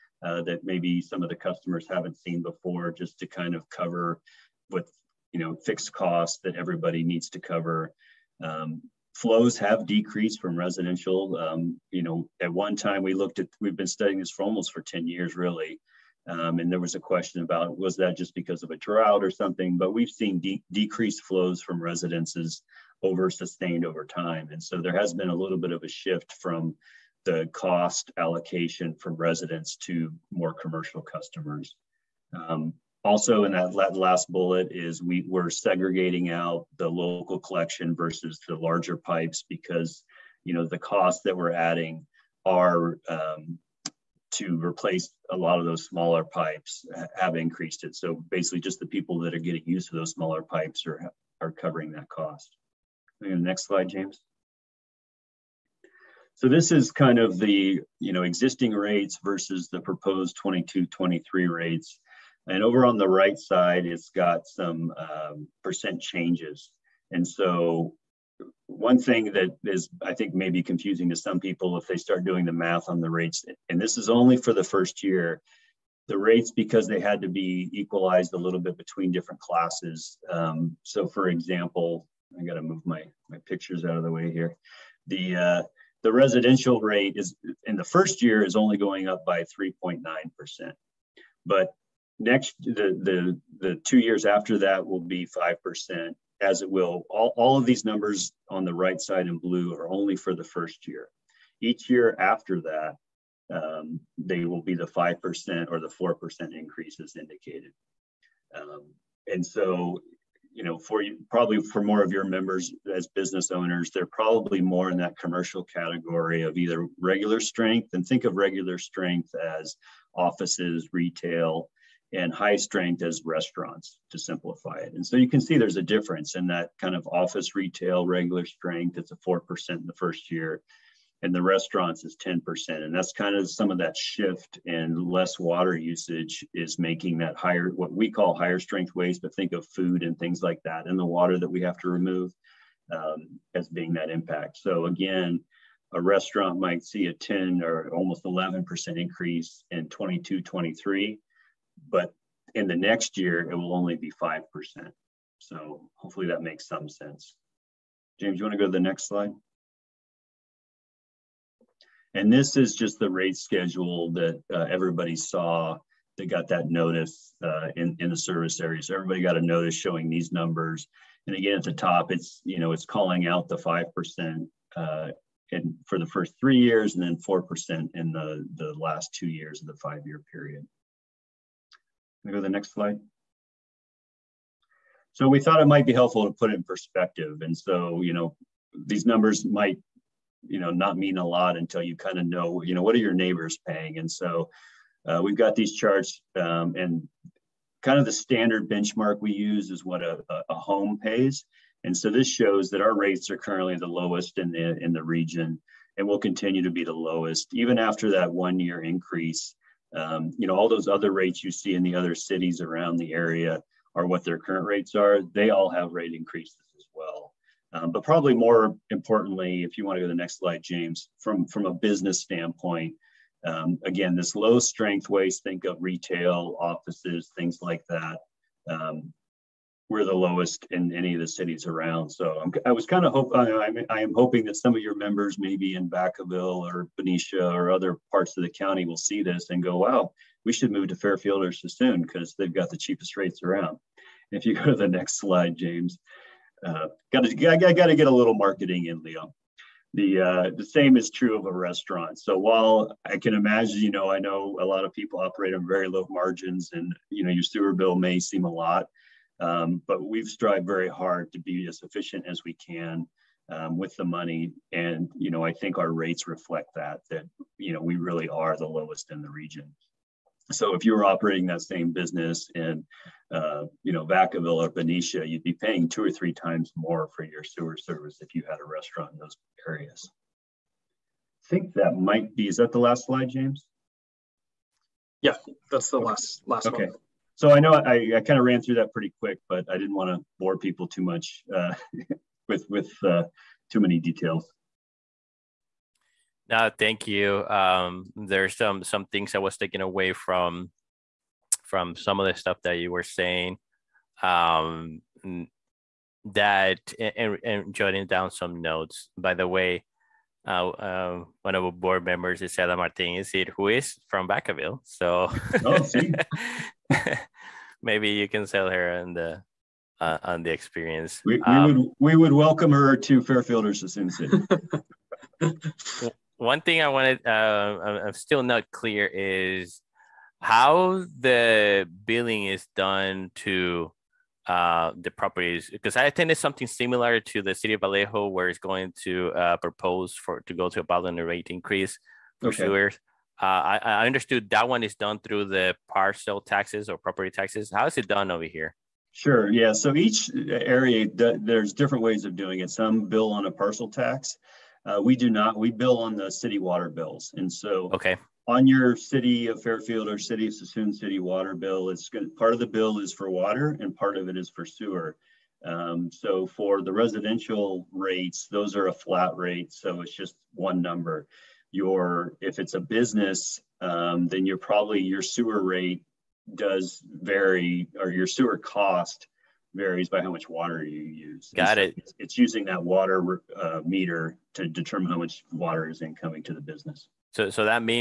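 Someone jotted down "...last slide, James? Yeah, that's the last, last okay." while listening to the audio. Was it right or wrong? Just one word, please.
right.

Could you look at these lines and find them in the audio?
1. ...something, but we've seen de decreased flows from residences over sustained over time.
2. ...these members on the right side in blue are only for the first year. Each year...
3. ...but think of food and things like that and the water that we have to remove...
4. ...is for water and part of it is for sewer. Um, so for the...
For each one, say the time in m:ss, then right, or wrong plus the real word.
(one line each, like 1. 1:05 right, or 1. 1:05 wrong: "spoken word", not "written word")
1. 0:19 right
2. 1:37 wrong: "numbers", not "members"
3. 2:19 right
4. 6:02 right.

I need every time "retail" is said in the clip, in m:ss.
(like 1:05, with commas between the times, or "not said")
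2:00, 2:07, 3:45.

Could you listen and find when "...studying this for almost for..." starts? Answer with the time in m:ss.
0:13.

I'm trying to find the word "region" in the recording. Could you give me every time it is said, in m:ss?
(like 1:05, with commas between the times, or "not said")
3:25, 4:29.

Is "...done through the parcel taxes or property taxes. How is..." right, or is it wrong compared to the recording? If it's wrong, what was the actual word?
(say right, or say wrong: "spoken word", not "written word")
right.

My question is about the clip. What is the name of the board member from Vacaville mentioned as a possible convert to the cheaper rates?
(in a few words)
Isela Martinez.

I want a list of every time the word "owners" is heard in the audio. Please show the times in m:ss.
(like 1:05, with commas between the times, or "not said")
1:53.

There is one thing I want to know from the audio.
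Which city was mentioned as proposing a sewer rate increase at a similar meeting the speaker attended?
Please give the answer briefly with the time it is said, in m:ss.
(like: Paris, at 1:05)
Vallejo, at 5:37.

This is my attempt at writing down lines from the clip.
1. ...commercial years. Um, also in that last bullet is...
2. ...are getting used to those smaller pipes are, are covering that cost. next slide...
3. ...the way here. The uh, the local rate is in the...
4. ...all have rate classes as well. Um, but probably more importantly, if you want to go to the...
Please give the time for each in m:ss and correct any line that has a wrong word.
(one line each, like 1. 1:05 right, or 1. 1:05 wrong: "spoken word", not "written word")
1. 0:30 wrong: "customers", not "years"
2. 0:49 right
3. 1:24 wrong: "residential", not "local"
4. 3:35 wrong: "increases", not "classes".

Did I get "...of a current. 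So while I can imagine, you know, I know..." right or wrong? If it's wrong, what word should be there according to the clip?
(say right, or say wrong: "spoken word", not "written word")
wrong: "restaurant", not "current".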